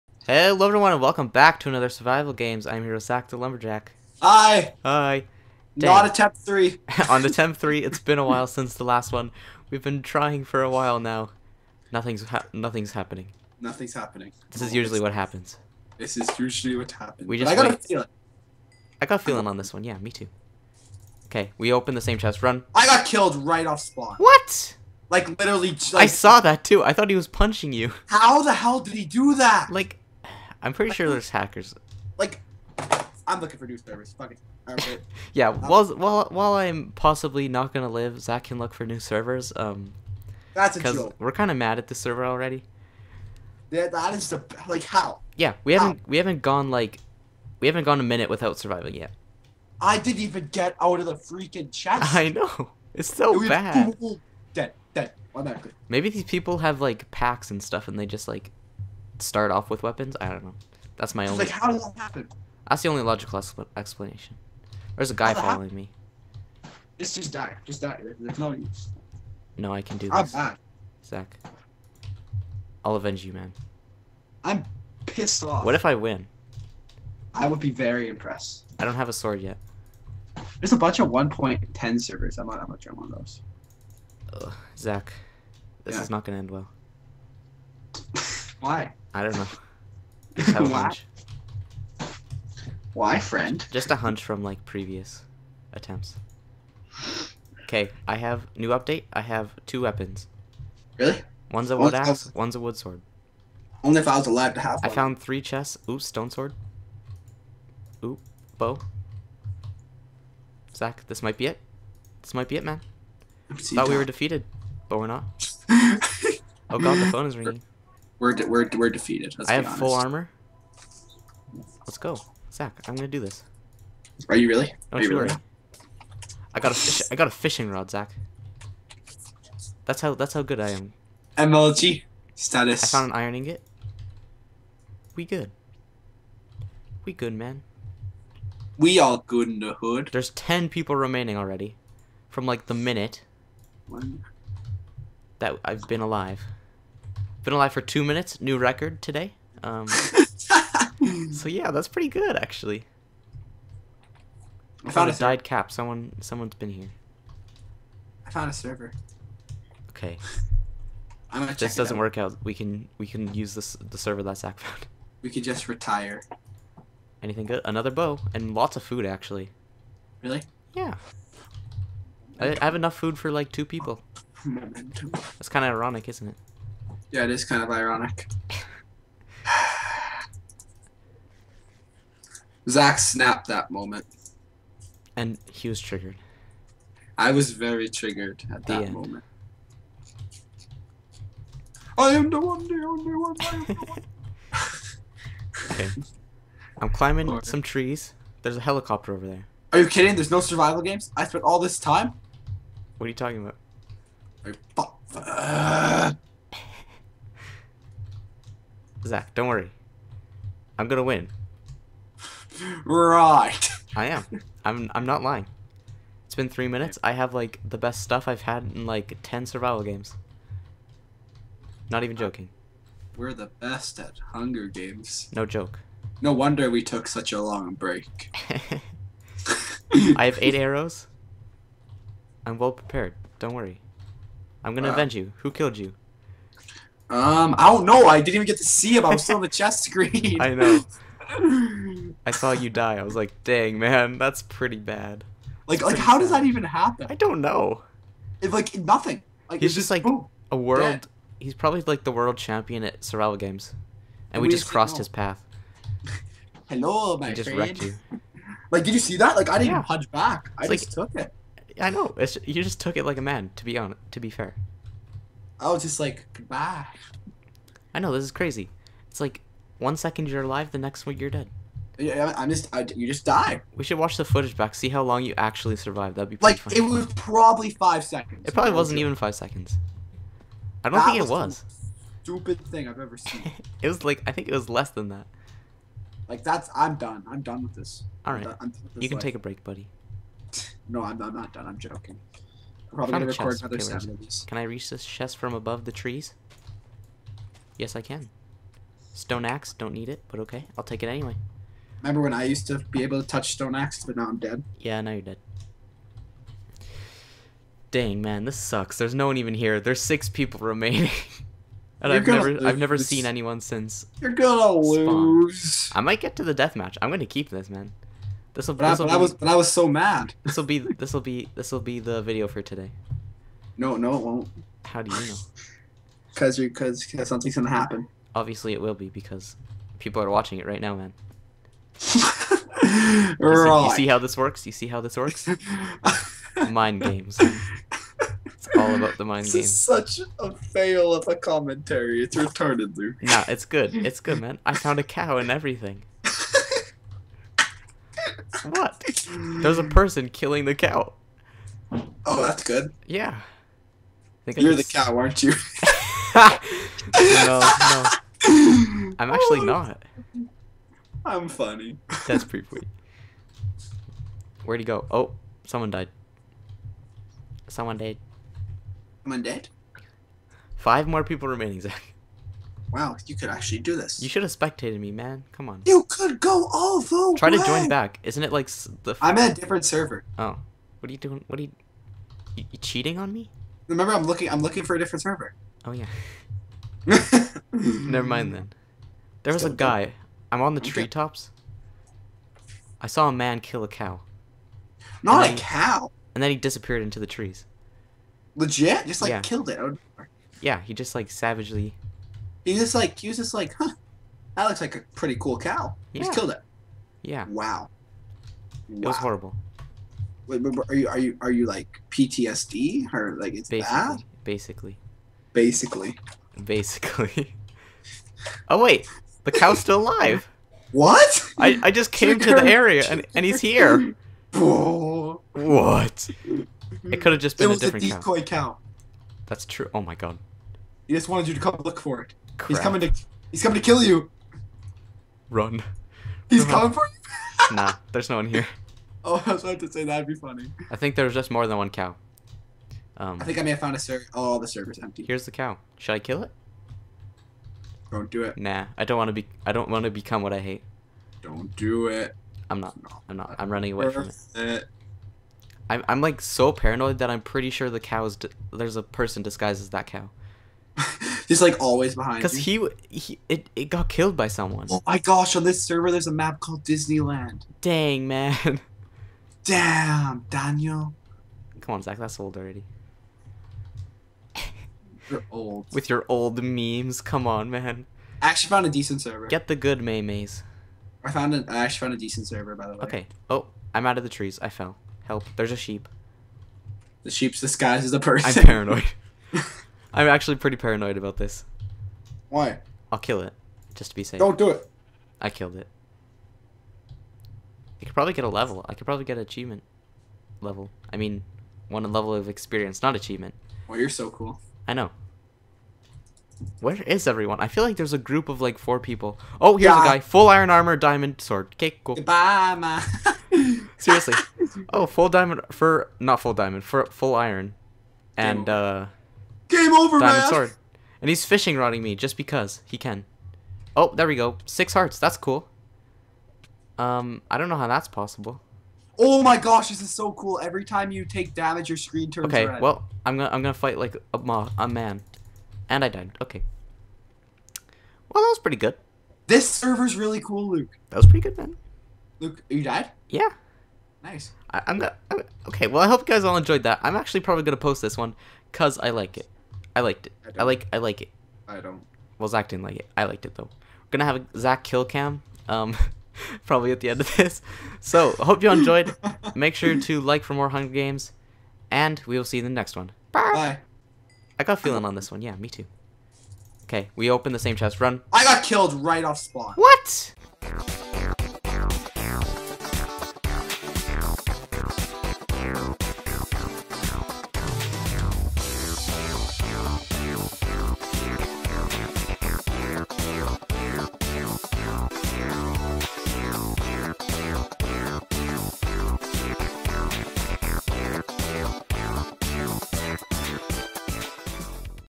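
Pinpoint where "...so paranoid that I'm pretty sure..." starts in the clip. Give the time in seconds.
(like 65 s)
456 s.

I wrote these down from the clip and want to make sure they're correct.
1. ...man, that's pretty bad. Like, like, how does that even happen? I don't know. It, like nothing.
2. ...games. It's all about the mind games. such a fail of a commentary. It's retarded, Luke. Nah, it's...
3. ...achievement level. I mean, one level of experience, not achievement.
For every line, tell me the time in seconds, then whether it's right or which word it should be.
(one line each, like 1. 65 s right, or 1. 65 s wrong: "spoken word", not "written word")
1. 243 s right
2. 337 s right
3. 499 s right.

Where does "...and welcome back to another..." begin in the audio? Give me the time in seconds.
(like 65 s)
0 s.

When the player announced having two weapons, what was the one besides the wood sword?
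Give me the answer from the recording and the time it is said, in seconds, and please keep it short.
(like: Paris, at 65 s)
Wood axe, at 101 s.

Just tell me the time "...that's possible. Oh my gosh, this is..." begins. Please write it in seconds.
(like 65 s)
527 s.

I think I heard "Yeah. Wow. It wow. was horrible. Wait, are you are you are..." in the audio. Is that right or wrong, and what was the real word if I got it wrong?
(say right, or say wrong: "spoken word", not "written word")
right.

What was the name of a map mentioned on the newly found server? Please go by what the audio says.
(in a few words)
Disneyland.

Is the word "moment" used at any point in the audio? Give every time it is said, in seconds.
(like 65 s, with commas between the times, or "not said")
183 s, 188 s.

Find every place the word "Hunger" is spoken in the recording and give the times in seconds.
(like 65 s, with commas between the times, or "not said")
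224 s, 560 s.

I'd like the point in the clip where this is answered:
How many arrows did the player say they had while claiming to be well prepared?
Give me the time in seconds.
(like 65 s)
230 s.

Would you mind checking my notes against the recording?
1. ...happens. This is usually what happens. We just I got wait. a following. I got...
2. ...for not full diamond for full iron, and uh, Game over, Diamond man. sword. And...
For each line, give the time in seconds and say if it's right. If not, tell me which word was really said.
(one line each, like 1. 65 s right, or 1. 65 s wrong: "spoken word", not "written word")
1. 15 s wrong: "feeling", not "following"
2. 515 s right.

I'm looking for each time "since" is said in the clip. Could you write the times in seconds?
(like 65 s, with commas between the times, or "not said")
8 s, 313 s.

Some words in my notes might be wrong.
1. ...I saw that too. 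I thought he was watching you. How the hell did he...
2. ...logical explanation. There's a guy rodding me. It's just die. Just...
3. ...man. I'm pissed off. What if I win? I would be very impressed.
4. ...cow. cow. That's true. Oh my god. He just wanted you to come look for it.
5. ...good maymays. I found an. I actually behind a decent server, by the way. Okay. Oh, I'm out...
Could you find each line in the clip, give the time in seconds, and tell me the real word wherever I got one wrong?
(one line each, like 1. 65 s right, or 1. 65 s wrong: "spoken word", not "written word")
1. 25 s wrong: "punching", not "watching"
2. 63 s wrong: "following", not "rodding"
3. 73 s right
4. 428 s right
5. 479 s wrong: "found", not "behind".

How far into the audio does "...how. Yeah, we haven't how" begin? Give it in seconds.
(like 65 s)
44 s.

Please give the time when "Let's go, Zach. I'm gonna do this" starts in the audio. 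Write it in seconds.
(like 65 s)
121 s.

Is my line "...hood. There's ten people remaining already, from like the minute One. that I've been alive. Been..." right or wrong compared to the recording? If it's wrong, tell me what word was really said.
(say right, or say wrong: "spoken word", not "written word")
right.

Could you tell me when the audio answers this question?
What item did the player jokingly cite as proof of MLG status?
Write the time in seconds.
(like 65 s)
127 s.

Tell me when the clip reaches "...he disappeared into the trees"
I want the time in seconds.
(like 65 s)
396 s.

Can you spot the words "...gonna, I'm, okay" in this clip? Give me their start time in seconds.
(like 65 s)
544 s.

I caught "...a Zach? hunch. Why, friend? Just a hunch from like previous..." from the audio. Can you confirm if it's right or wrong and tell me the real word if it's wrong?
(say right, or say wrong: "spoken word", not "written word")
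wrong: "Why", not "Zach".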